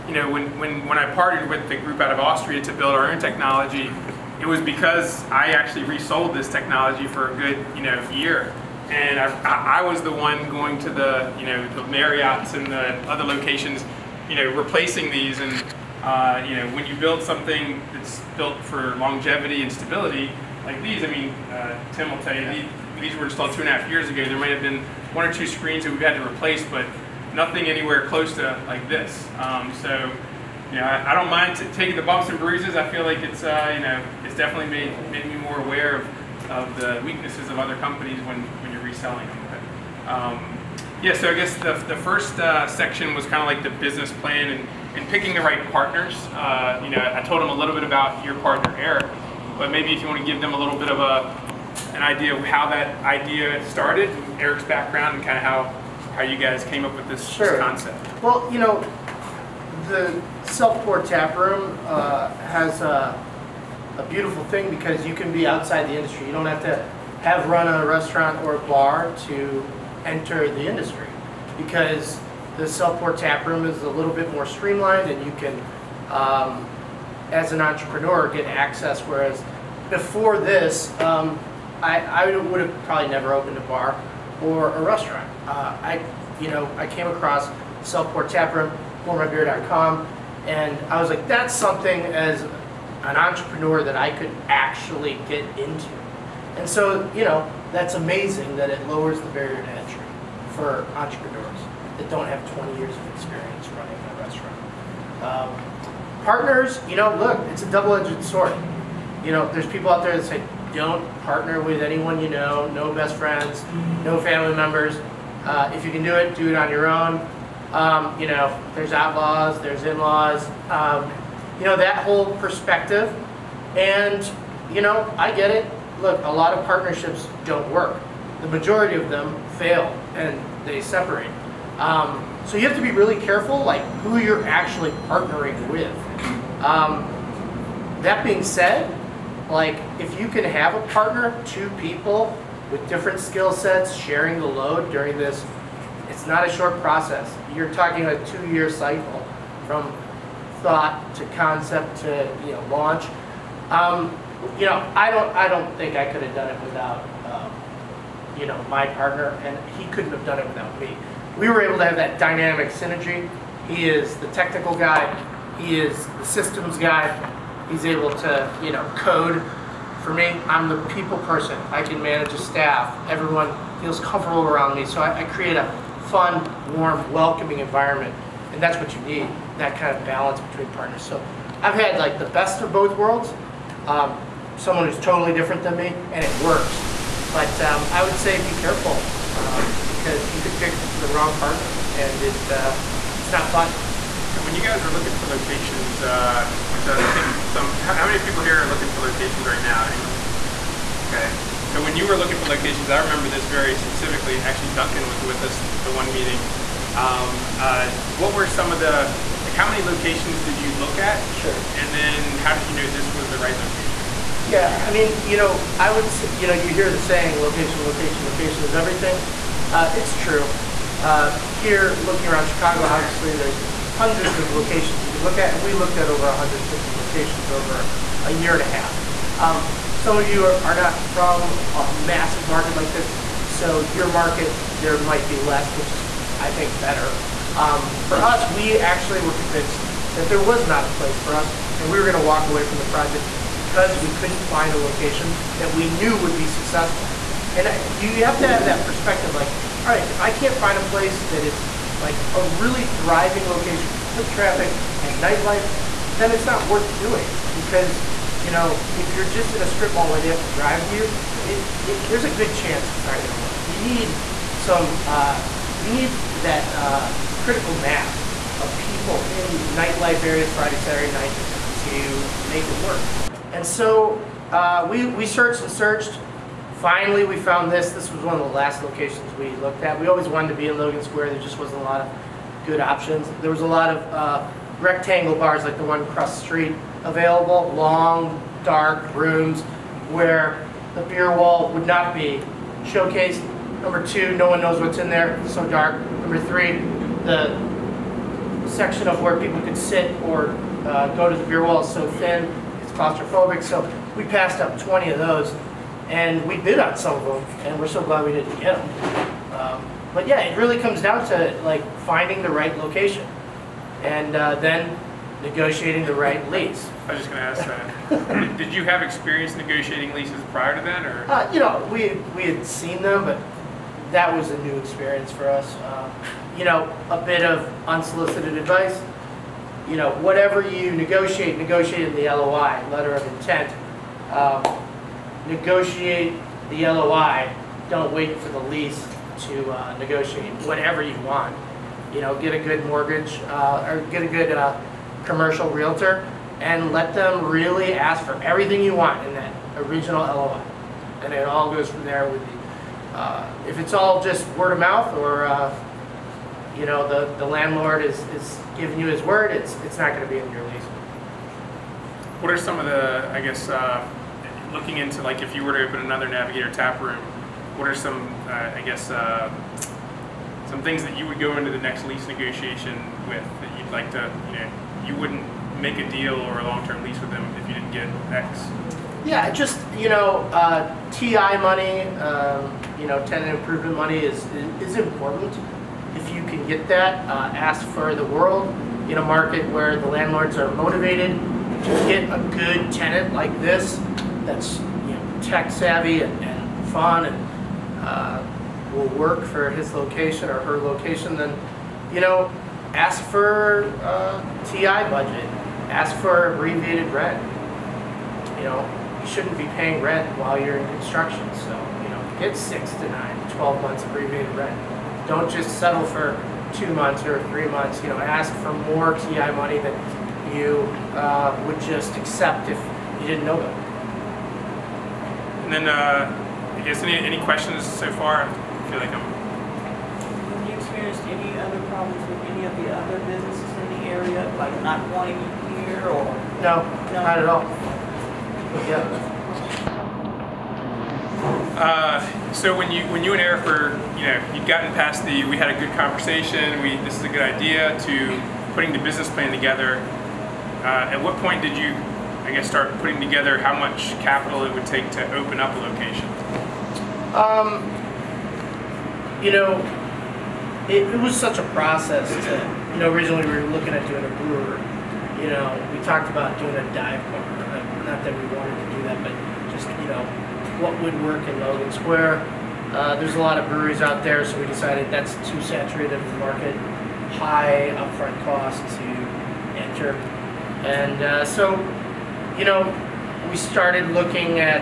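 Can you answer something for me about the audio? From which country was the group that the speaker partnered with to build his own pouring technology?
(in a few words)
Austria.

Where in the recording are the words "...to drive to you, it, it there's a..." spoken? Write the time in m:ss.
4:20.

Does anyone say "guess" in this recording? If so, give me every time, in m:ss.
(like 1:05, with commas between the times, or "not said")
0:41, 6:03, 6:08, 7:06, 7:32.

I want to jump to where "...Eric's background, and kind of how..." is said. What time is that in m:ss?
0:54.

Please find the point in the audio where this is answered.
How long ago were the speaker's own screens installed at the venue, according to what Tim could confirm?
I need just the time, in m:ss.
0:23.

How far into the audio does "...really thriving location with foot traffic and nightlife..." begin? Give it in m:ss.
4:12.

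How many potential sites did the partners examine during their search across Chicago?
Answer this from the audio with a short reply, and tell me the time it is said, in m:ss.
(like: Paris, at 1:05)
Over 150, at 3:46.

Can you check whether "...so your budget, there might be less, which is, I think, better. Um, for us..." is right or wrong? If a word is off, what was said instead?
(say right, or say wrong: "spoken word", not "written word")
wrong: "market", not "budget".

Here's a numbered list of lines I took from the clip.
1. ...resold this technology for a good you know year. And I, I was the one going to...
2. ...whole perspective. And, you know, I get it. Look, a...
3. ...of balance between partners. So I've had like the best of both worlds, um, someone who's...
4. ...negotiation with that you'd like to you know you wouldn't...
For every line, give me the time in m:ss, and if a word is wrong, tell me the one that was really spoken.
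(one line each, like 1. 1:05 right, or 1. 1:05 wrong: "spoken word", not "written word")
1. 0:05 right
2. 2:02 right
3. 2:59 right
4. 6:12 right.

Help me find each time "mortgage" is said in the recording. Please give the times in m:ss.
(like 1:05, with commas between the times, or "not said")
5:42.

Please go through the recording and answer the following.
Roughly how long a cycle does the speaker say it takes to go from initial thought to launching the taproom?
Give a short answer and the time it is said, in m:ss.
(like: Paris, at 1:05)
2 years, at 2:28.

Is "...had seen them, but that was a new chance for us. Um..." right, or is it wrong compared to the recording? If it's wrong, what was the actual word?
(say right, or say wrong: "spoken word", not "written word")
wrong: "experience", not "chance".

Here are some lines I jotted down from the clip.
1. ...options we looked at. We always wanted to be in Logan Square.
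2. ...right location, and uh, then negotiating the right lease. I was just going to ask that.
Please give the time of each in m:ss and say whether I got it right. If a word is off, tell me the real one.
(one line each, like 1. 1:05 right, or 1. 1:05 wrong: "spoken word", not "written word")
1. 4:38 wrong: "locations", not "options"
2. 5:12 right.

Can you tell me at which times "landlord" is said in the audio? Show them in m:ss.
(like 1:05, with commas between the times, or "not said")
5:57, 6:30.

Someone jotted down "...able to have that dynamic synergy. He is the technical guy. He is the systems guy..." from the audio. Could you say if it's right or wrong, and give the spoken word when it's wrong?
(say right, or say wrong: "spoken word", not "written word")
right.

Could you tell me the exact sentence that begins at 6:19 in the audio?
Yeah, just you know, uh, TI money, um, you know, tenant improvement money is is important.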